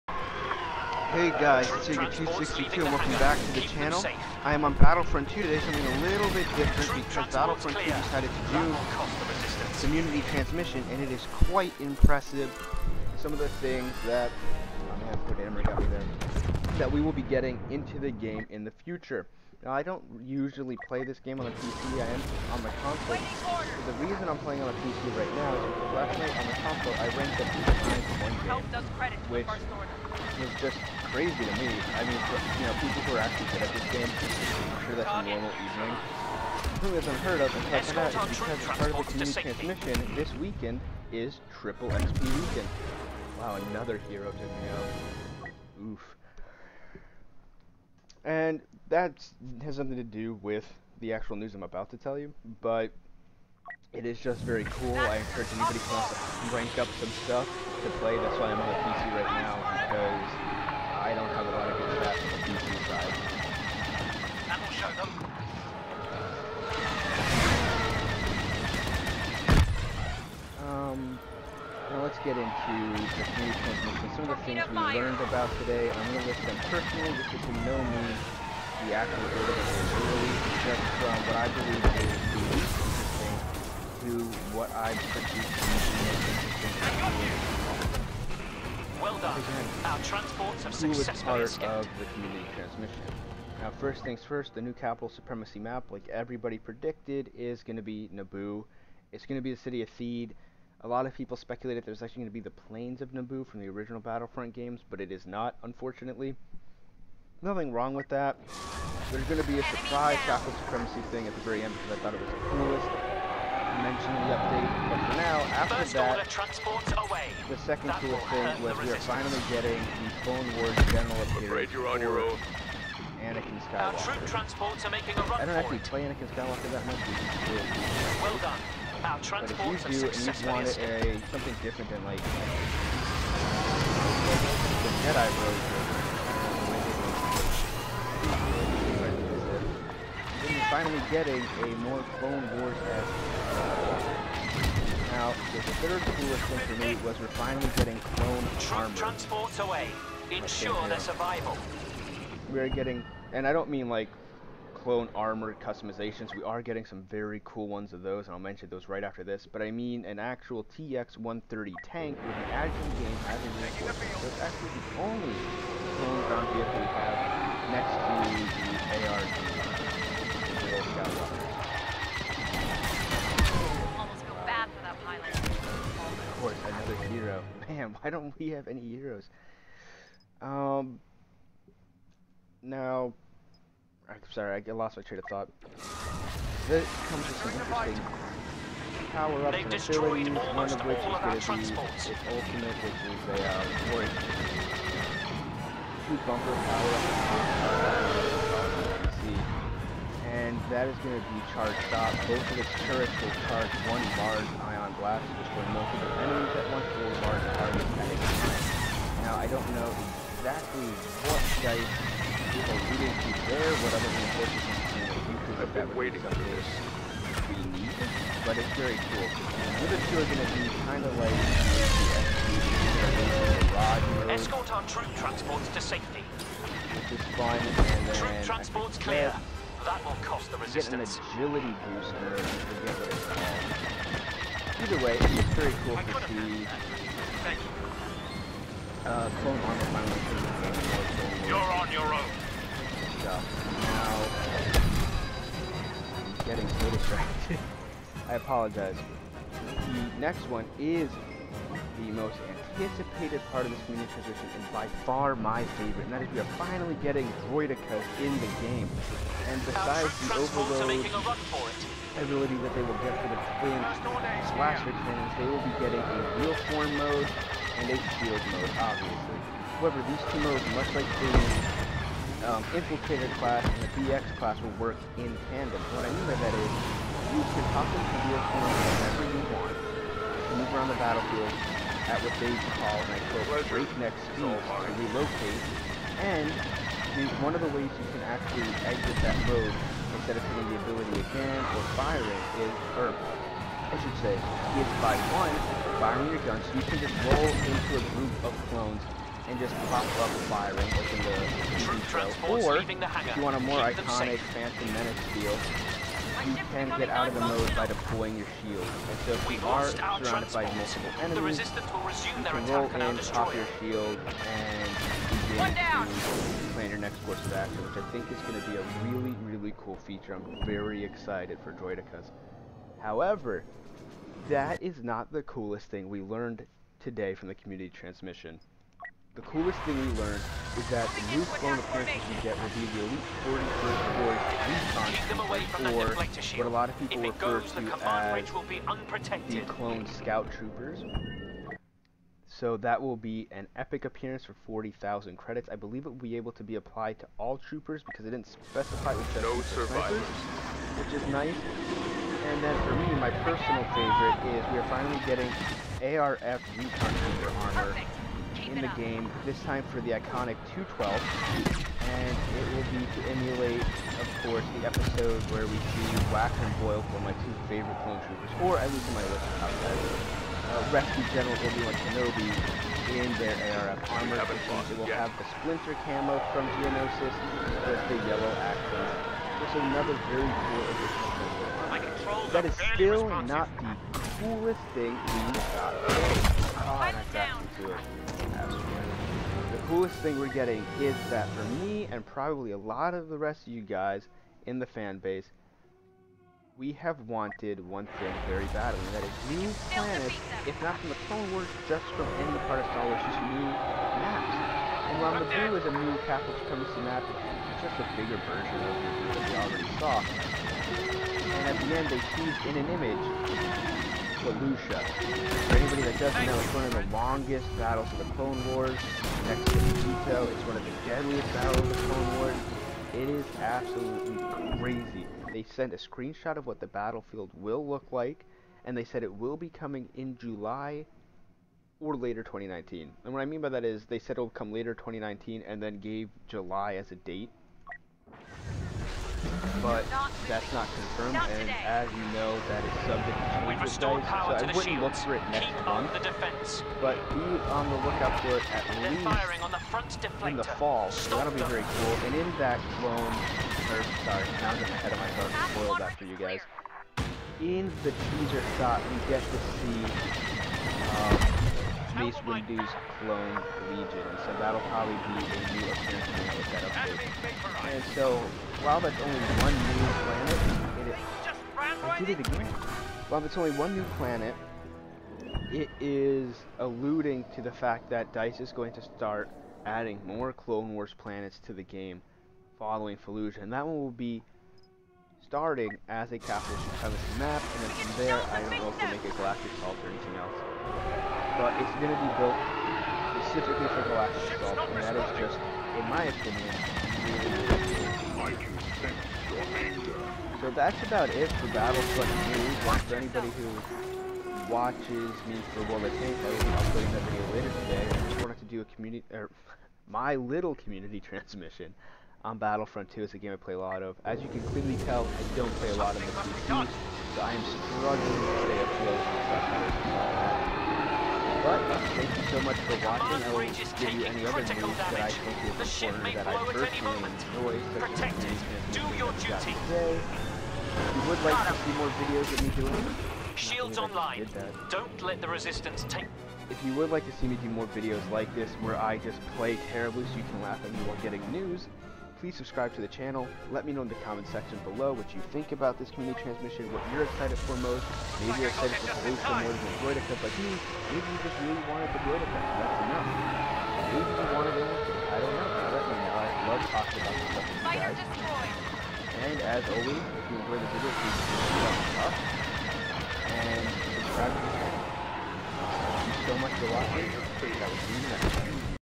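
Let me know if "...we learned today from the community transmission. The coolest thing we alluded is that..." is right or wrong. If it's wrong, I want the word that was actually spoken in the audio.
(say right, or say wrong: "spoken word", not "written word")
wrong: "learned", not "alluded".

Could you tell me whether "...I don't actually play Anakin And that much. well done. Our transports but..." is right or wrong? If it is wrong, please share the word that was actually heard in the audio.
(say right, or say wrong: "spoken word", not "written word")
wrong: "Skywalker", not "And".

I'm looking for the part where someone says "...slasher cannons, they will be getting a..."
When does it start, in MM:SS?
04:24.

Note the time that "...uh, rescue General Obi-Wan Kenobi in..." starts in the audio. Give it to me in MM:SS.
06:09.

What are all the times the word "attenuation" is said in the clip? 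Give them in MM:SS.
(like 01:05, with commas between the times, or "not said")
not said.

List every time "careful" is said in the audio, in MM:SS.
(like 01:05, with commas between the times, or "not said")
not said.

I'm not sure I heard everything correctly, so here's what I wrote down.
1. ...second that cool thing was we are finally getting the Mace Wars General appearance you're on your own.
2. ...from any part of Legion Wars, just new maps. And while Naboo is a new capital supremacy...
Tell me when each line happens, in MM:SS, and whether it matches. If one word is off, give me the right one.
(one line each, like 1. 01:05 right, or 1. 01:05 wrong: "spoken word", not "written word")
1. 01:57 wrong: "Clone", not "Mace"
2. 06:42 wrong: "Star", not "Legion".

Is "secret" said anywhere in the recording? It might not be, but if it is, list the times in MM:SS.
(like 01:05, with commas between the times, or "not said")
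not said.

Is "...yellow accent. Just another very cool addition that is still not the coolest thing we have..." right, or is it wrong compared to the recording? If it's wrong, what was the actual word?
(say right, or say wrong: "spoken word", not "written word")
right.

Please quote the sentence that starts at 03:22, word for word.
Both of its turrets will charge one large ion blast to destroy enemies at once or large targets at a time.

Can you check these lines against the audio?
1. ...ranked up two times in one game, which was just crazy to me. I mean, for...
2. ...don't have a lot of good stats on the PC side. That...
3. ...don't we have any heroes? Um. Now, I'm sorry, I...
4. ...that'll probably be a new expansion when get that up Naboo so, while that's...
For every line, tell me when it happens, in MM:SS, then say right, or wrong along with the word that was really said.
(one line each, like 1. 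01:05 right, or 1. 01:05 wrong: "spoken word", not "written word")
1. 00:27 right
2. 01:01 right
3. 02:58 right
4. 07:44 wrong: "And", not "Naboo".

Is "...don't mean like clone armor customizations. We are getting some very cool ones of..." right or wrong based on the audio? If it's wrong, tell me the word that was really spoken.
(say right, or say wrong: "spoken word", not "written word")
right.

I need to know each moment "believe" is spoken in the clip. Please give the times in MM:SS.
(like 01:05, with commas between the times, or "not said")
01:21, 05:45.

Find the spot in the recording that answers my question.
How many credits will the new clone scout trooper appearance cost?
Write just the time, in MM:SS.
05:44.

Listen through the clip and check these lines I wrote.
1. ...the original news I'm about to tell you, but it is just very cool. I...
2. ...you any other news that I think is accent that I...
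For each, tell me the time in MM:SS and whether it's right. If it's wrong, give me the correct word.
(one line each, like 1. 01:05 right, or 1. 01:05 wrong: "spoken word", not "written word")
1. 00:51 wrong: "actual", not "original"
2. 08:44 wrong: "important", not "accent".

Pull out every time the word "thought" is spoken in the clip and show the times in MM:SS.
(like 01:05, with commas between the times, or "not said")
01:52, 03:05.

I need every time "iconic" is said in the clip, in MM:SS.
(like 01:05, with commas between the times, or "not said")
05:04, 06:00.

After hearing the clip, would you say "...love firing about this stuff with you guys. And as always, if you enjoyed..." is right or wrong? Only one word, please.
wrong.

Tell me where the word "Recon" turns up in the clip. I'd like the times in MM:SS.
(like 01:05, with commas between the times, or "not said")
05:35, 05:56.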